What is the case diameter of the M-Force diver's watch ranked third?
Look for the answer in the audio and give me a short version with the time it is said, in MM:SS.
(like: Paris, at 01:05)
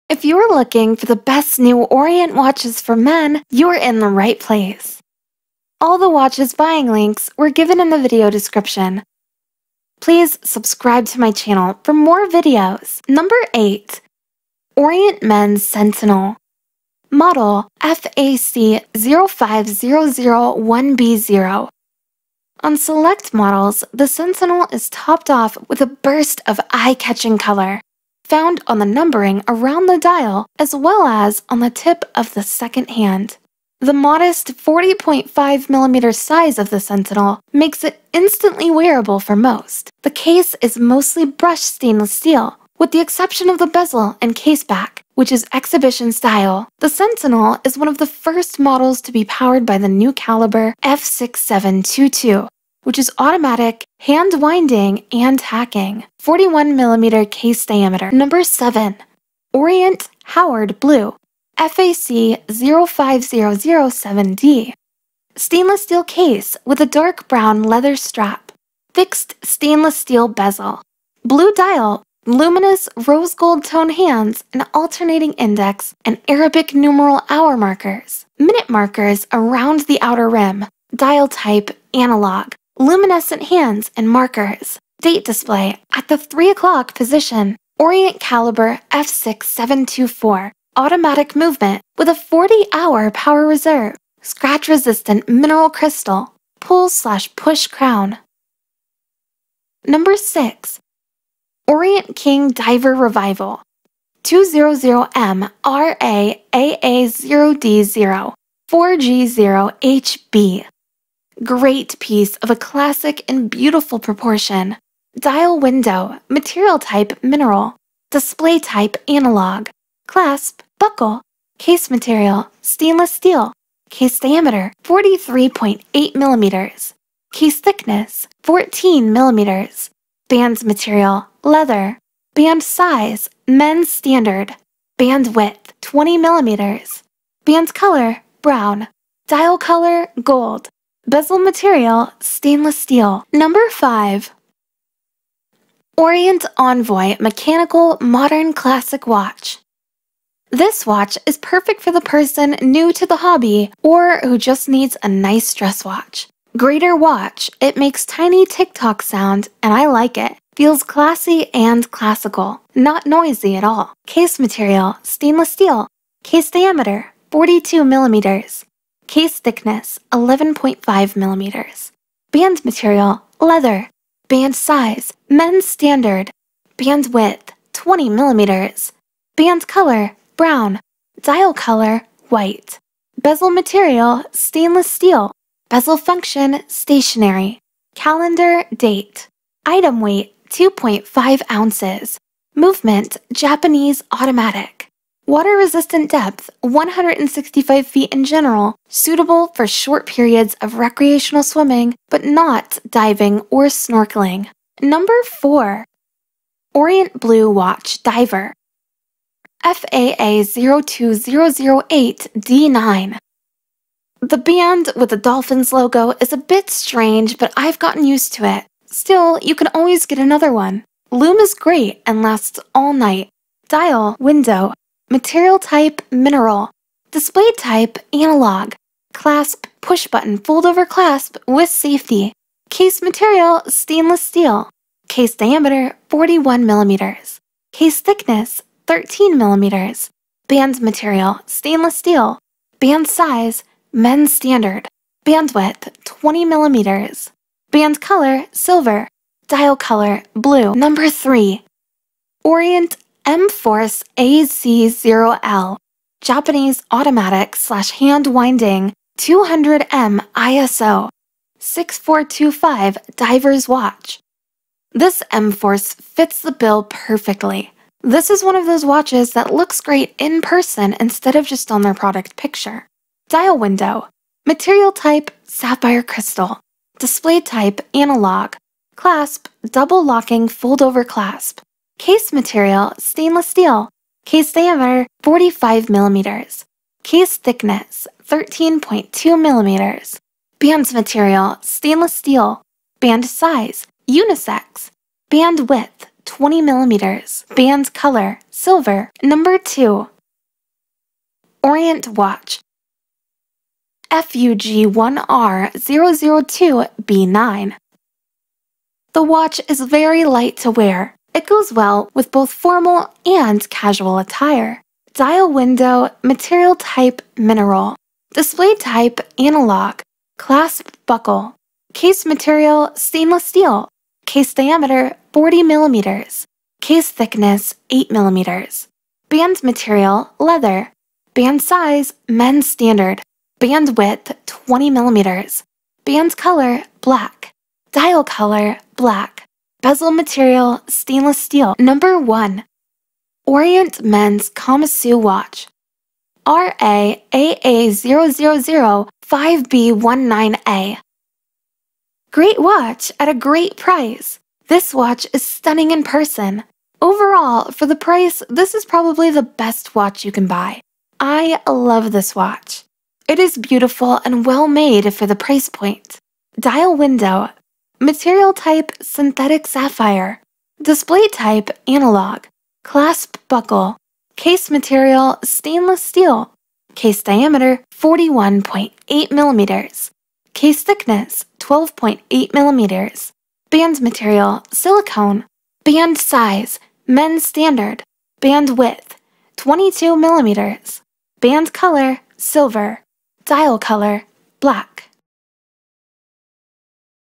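45 millimeters, at 04:45.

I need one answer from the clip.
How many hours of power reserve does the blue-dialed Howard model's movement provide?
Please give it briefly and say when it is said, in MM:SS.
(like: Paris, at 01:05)
40 hours, at 01:32.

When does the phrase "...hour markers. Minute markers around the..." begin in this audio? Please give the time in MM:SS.
01:17.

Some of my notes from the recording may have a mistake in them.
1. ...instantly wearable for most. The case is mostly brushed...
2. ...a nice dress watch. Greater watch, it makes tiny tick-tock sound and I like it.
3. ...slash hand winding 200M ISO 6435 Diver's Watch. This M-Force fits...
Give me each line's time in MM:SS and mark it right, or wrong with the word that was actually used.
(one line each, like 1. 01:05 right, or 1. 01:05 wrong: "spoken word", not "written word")
1. 00:38 right
2. 02:35 right
3. 04:17 wrong: "6425", not "6435".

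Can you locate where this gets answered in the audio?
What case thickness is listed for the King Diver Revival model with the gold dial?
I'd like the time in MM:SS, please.
02:08.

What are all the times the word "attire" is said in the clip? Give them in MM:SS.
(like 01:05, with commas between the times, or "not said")
05:14.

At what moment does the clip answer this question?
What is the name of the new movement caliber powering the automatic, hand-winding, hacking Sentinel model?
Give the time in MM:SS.
00:50.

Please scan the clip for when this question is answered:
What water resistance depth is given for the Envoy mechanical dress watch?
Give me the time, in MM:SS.
03:16.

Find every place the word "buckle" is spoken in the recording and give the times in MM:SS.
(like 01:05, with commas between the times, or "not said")
02:00, 05:21, 06:13.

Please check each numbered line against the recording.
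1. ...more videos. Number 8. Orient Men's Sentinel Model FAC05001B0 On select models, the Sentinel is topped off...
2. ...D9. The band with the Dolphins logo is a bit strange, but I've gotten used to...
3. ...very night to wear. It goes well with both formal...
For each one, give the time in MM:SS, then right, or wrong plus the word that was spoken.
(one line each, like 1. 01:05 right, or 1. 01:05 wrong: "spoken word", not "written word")
1. 00:11 right
2. 03:32 right
3. 05:09 wrong: "light", not "night".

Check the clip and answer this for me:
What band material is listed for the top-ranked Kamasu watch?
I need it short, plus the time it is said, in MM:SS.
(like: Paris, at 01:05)
Silicone, at 06:24.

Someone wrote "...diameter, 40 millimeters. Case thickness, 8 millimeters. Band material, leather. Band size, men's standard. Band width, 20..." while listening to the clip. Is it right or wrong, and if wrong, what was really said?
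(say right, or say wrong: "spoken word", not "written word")
right.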